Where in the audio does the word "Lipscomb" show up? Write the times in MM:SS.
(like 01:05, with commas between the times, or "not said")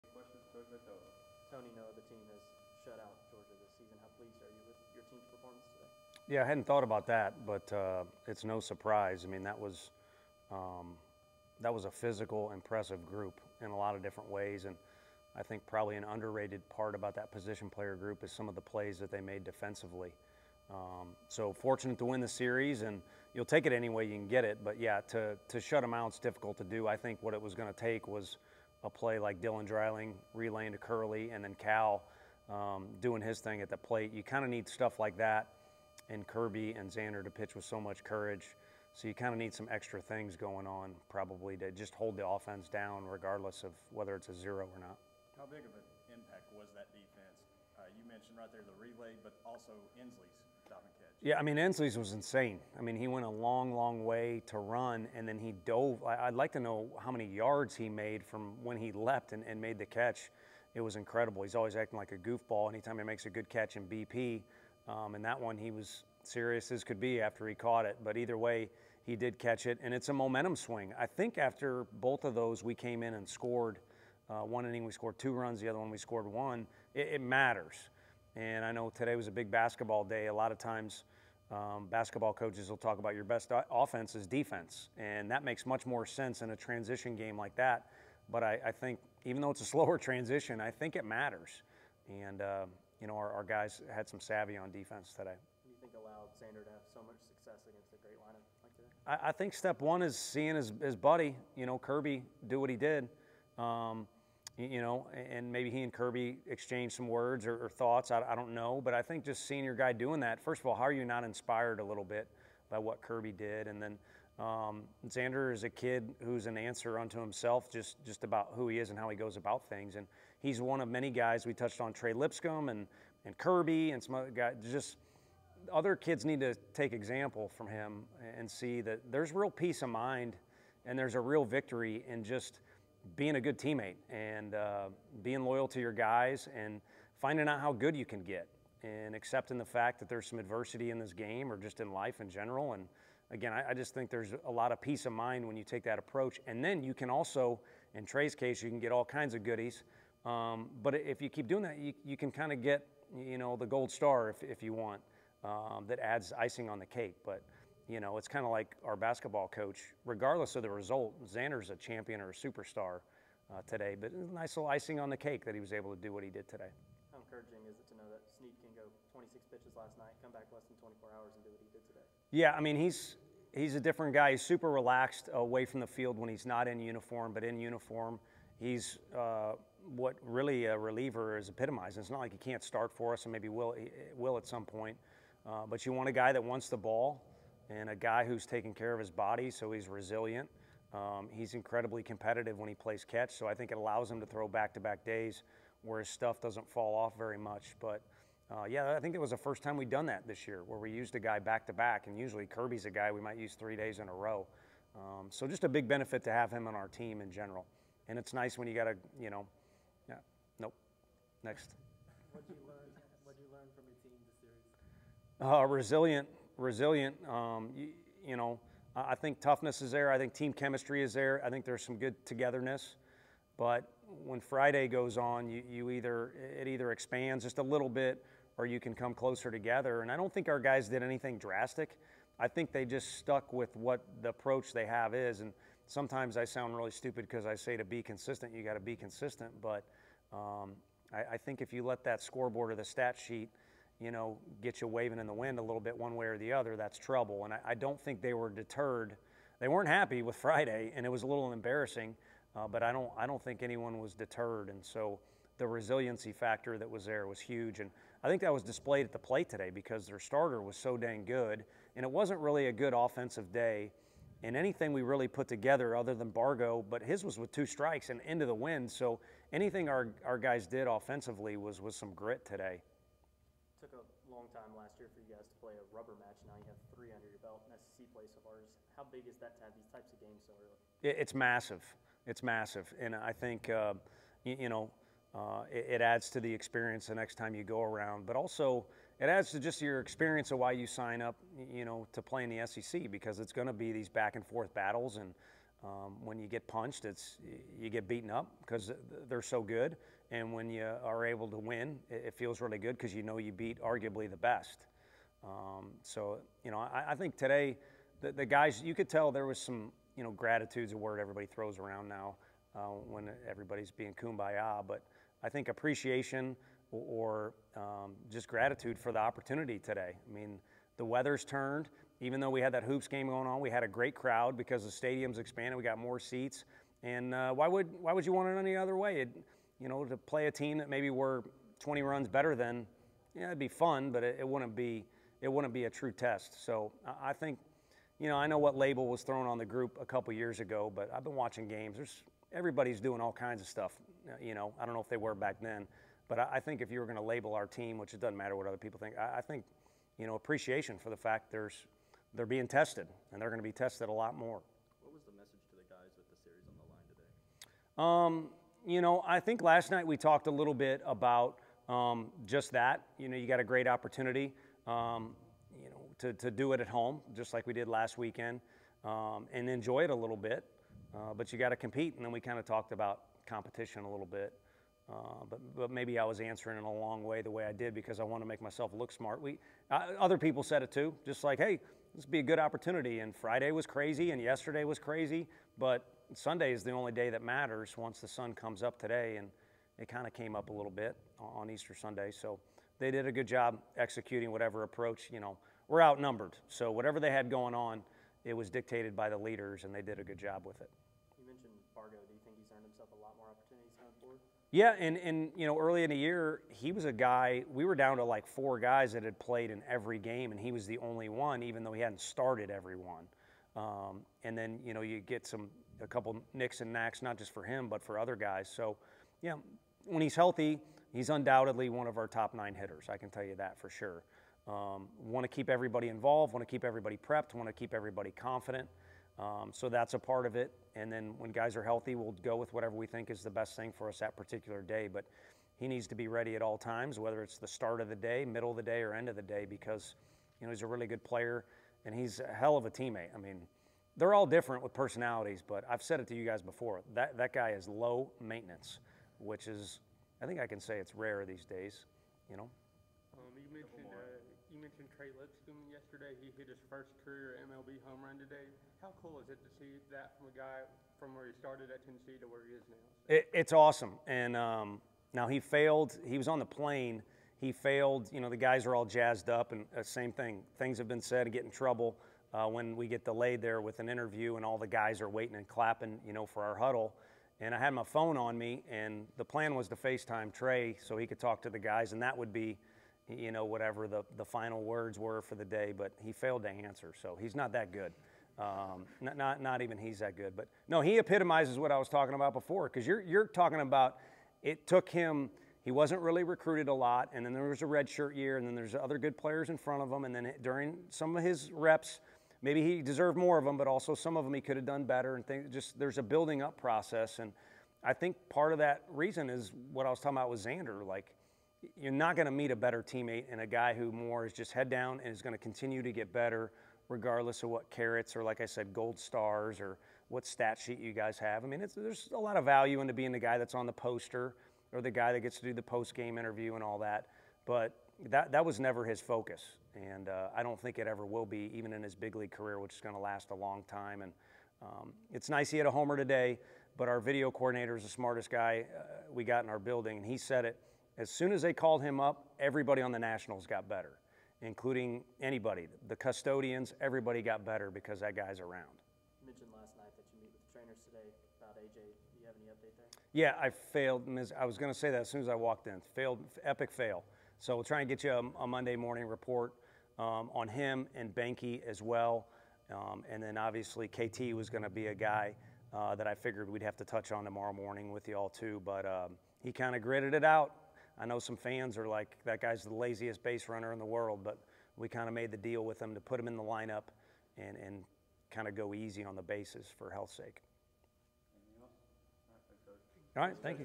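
02:02, 07:35.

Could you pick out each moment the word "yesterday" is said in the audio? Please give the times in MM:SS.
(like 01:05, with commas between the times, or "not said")
06:24, 07:35.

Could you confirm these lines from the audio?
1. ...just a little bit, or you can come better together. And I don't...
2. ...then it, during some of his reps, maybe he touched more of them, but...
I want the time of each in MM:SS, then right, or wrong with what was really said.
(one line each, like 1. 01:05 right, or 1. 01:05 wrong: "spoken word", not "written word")
1. 03:47 wrong: "closer", not "better"
2. 08:20 wrong: "deserved", not "touched".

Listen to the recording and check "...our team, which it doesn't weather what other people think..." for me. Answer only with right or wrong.
wrong.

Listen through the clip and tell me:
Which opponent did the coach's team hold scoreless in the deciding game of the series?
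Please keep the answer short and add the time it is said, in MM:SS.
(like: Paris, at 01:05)
Georgia, at 00:03.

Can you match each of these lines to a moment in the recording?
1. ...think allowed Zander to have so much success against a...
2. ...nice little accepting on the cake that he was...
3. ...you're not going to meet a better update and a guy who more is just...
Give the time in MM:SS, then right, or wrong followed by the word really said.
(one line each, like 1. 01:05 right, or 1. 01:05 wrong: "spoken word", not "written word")
1. 01:35 right
2. 02:44 wrong: "icing", not "accepting"
3. 08:31 wrong: "teammate", not "update".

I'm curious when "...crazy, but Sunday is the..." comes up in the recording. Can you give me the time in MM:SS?
06:24.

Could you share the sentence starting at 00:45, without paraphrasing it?
How big of an impact was that defense?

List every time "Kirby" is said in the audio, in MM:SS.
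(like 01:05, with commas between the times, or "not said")
00:36, 01:41, 01:45, 01:53, 02:03, 03:22.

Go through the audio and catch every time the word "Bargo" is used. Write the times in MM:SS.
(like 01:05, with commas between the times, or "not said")
04:26, 06:42.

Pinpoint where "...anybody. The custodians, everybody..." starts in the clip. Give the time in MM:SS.
09:05.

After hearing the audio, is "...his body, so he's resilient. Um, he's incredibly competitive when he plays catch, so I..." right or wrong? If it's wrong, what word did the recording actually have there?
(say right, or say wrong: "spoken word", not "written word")
right.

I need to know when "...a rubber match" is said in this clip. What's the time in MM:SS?
04:35.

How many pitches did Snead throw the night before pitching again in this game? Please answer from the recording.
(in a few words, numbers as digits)
26.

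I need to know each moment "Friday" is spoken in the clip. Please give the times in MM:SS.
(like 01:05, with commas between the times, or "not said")
03:44, 04:10, 06:23.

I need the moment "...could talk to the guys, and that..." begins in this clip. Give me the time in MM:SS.
08:01.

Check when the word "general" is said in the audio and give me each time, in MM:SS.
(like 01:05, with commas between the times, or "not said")
02:22, 03:27.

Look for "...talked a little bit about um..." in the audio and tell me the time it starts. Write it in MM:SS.
06:00.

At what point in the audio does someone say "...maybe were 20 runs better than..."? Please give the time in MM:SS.
05:30.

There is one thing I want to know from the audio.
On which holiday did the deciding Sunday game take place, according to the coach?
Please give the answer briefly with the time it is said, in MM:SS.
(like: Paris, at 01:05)
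Easter Sunday, at 06:31.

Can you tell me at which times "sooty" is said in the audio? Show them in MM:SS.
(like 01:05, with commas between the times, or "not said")
not said.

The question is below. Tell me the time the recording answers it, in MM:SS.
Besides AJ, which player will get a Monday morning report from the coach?
09:21.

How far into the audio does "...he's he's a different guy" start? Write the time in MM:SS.
02:52.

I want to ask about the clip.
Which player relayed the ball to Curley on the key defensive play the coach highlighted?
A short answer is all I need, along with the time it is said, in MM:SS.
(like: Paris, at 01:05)
Dylan Dreiling, at 00:29.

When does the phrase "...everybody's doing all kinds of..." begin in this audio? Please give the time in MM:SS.
05:42.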